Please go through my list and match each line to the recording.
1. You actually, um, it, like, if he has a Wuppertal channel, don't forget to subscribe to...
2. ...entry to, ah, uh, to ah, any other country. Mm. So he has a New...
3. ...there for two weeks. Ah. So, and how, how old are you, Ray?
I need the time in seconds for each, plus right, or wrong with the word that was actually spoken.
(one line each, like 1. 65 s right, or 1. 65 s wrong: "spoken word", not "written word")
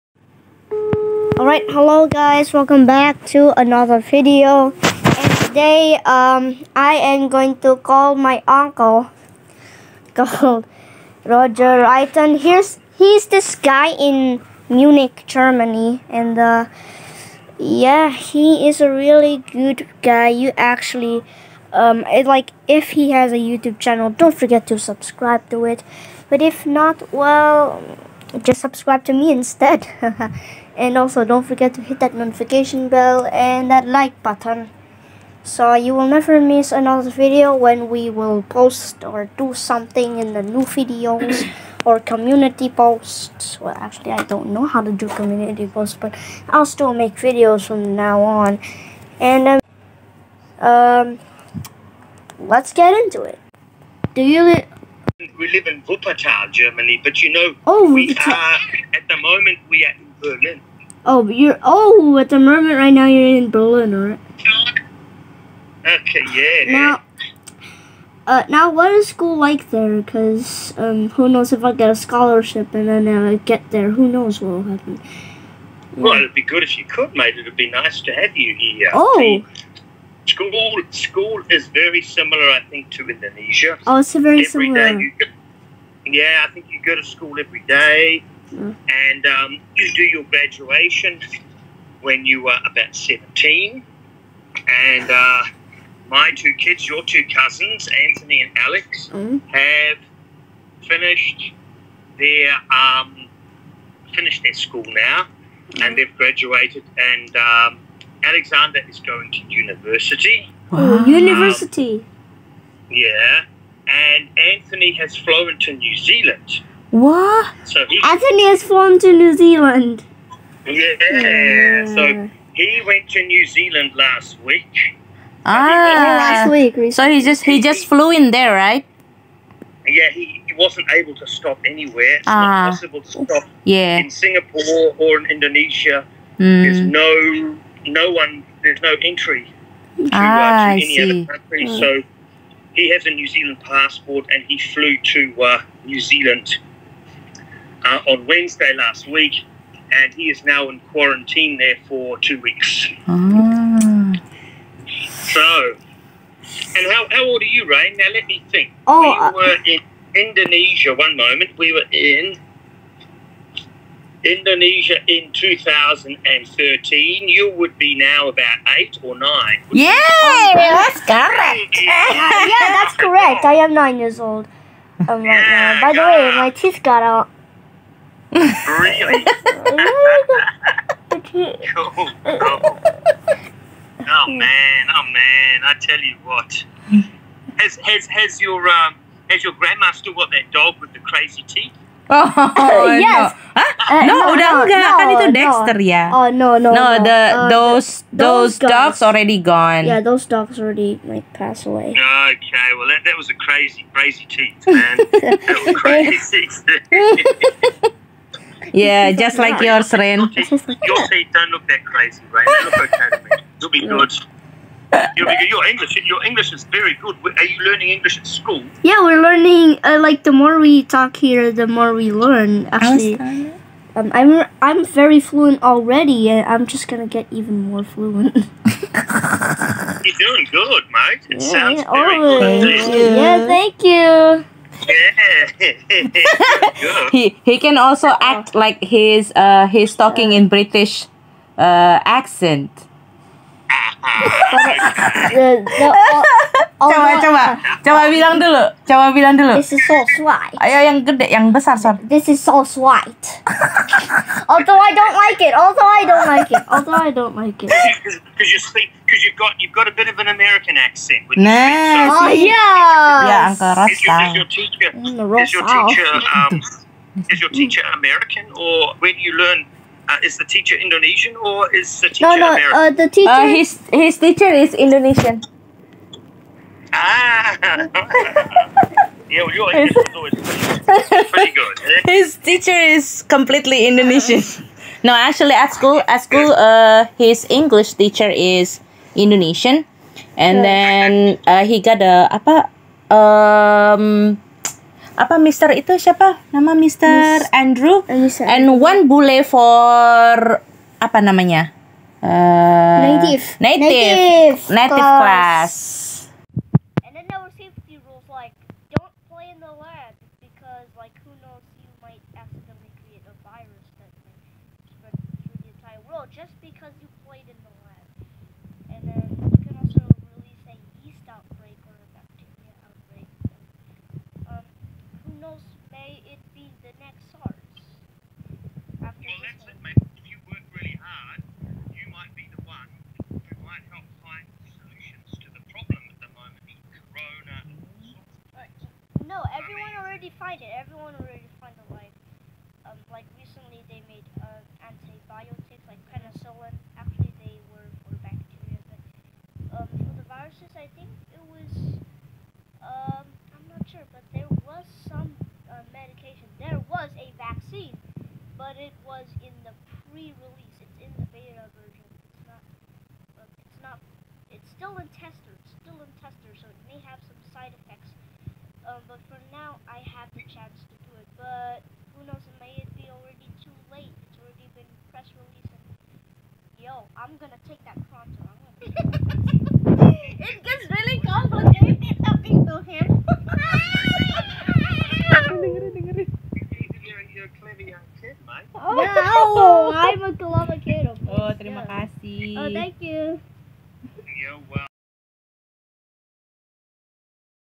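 1. 20 s wrong: "YouTube", not "Wuppertal"
2. 139 s right
3. 151 s right.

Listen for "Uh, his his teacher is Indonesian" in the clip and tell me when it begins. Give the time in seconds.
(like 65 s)
273 s.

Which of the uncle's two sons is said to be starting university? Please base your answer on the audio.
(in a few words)
Alexander.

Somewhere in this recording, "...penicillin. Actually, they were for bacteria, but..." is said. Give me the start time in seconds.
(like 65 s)
346 s.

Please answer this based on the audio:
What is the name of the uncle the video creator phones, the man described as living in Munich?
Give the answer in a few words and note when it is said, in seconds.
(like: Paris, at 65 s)
Roger Reiton, at 11 s.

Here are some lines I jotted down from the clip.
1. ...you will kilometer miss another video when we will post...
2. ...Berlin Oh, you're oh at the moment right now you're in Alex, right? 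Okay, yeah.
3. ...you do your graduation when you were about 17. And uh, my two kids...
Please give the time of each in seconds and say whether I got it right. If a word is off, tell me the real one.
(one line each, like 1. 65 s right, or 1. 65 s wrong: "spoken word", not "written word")
1. 35 s wrong: "never", not "kilometer"
2. 60 s wrong: "Berlin", not "Alex"
3. 89 s right.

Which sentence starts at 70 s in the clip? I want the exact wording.
Cause um, who knows if I get a scholarship and then I get there, who knows what will happen.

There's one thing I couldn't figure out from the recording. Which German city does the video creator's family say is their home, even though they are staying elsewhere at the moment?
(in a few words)
Wuppertal.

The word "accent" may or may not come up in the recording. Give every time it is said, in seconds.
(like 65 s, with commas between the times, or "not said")
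242 s, 260 s.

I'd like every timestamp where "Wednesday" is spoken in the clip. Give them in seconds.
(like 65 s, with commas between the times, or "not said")
148 s.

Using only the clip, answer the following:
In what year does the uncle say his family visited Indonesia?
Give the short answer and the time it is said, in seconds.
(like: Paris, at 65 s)
2013, at 165 s.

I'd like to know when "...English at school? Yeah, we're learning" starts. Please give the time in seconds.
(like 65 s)
217 s.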